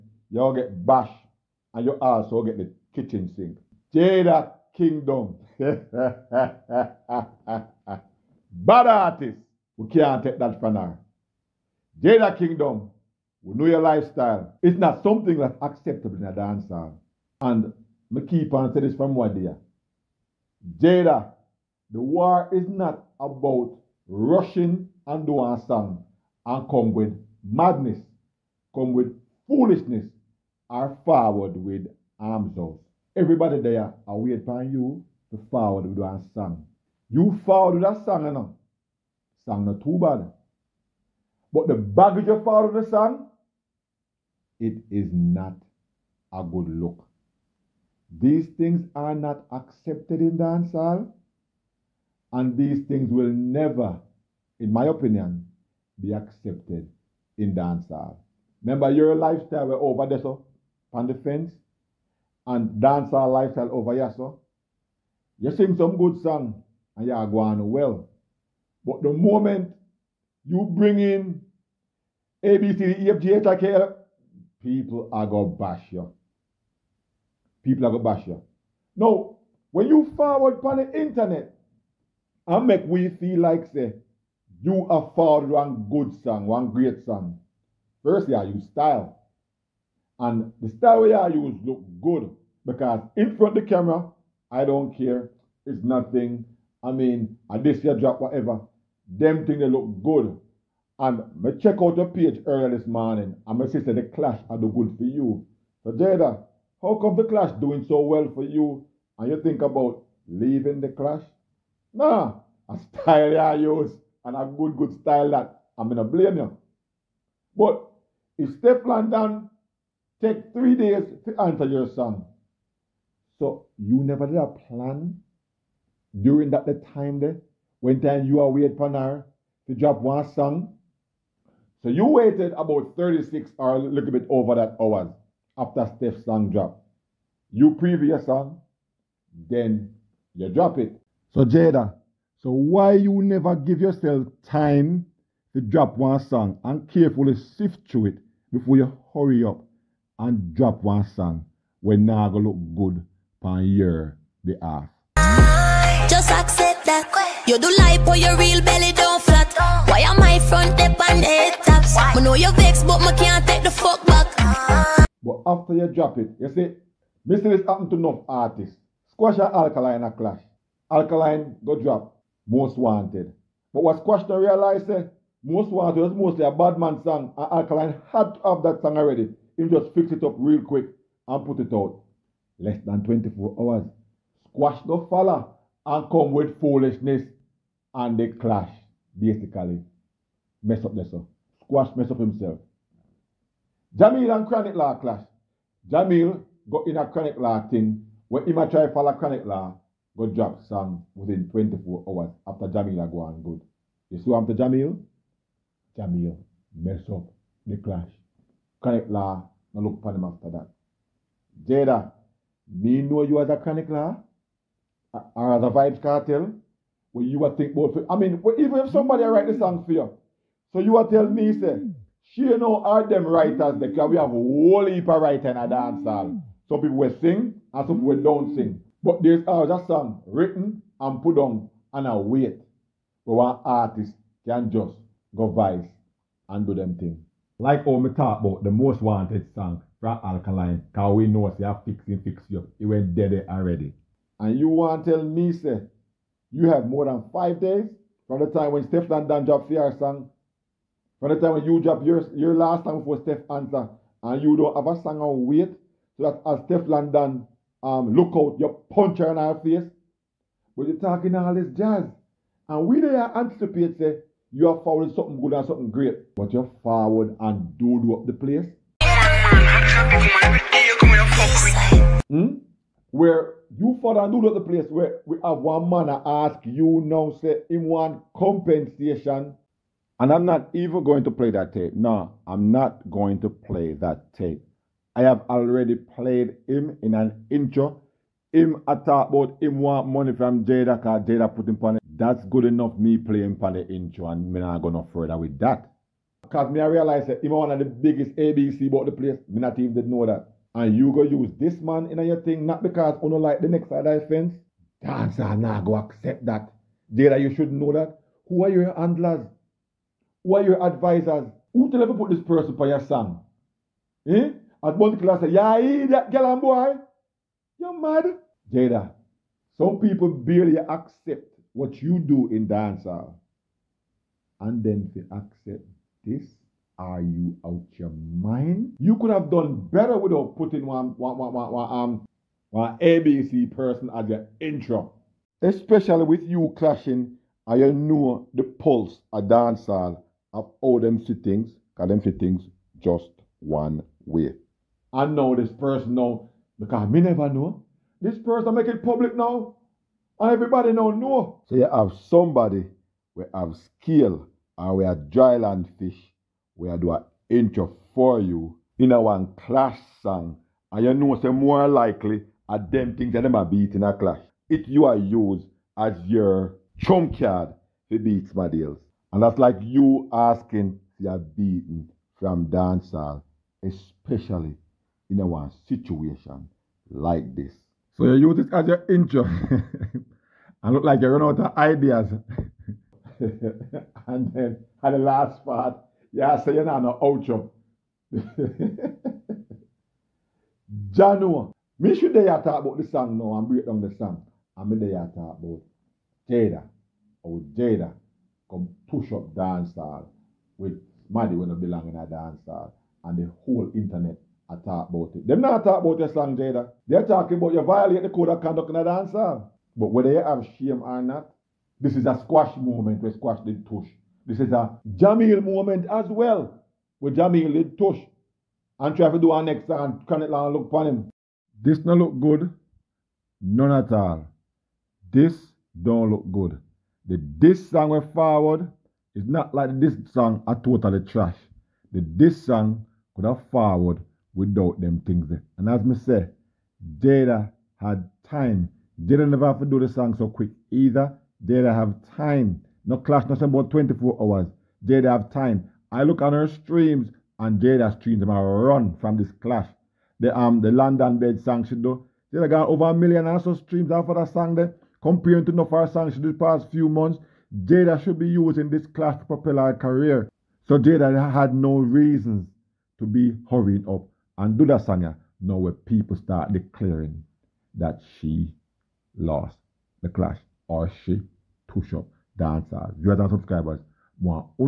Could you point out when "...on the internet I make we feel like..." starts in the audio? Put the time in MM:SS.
01:20.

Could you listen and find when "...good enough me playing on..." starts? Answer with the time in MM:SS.
04:52.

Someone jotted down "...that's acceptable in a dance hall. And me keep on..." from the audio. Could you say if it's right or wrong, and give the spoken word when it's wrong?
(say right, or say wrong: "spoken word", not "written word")
right.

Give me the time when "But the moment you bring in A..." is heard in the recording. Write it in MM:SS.
01:08.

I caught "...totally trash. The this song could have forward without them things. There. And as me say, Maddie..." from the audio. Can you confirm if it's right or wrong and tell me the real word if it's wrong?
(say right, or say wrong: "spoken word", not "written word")
wrong: "Jada", not "Maddie".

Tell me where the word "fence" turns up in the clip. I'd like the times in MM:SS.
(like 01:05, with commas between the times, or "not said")
01:01, 05:04.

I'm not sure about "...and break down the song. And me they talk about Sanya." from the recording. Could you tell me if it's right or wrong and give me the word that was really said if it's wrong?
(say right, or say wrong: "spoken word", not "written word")
wrong: "Jada", not "Sanya".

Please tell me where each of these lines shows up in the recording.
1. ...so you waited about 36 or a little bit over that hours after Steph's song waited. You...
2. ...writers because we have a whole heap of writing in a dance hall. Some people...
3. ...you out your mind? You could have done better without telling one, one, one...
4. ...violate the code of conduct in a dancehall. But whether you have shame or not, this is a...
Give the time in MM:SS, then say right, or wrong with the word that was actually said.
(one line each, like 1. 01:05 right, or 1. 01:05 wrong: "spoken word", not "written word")
1. 02:11 wrong: "dropped", not "waited"
2. 03:43 right
3. 05:27 wrong: "putting", not "telling"
4. 06:47 right.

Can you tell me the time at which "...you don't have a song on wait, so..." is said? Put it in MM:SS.
04:14.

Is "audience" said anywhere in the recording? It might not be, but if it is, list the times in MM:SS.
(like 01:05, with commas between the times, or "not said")
not said.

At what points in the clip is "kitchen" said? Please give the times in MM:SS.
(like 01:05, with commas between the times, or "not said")
00:02.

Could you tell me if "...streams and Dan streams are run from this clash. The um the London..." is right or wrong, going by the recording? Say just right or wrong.
wrong.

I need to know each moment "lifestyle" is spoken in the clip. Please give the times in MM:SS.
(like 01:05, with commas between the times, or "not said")
00:13, 00:59, 01:03.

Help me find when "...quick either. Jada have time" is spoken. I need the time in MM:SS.
07:20.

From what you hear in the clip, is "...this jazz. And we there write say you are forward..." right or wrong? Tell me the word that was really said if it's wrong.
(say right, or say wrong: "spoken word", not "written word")
wrong: "anticipate", not "write".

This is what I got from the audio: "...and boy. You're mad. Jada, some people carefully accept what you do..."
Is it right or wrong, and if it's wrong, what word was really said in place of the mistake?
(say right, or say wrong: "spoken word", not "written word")
wrong: "barely", not "carefully".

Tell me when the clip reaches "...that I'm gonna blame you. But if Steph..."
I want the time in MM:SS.
01:55.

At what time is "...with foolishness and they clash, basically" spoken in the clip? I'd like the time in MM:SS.
03:06.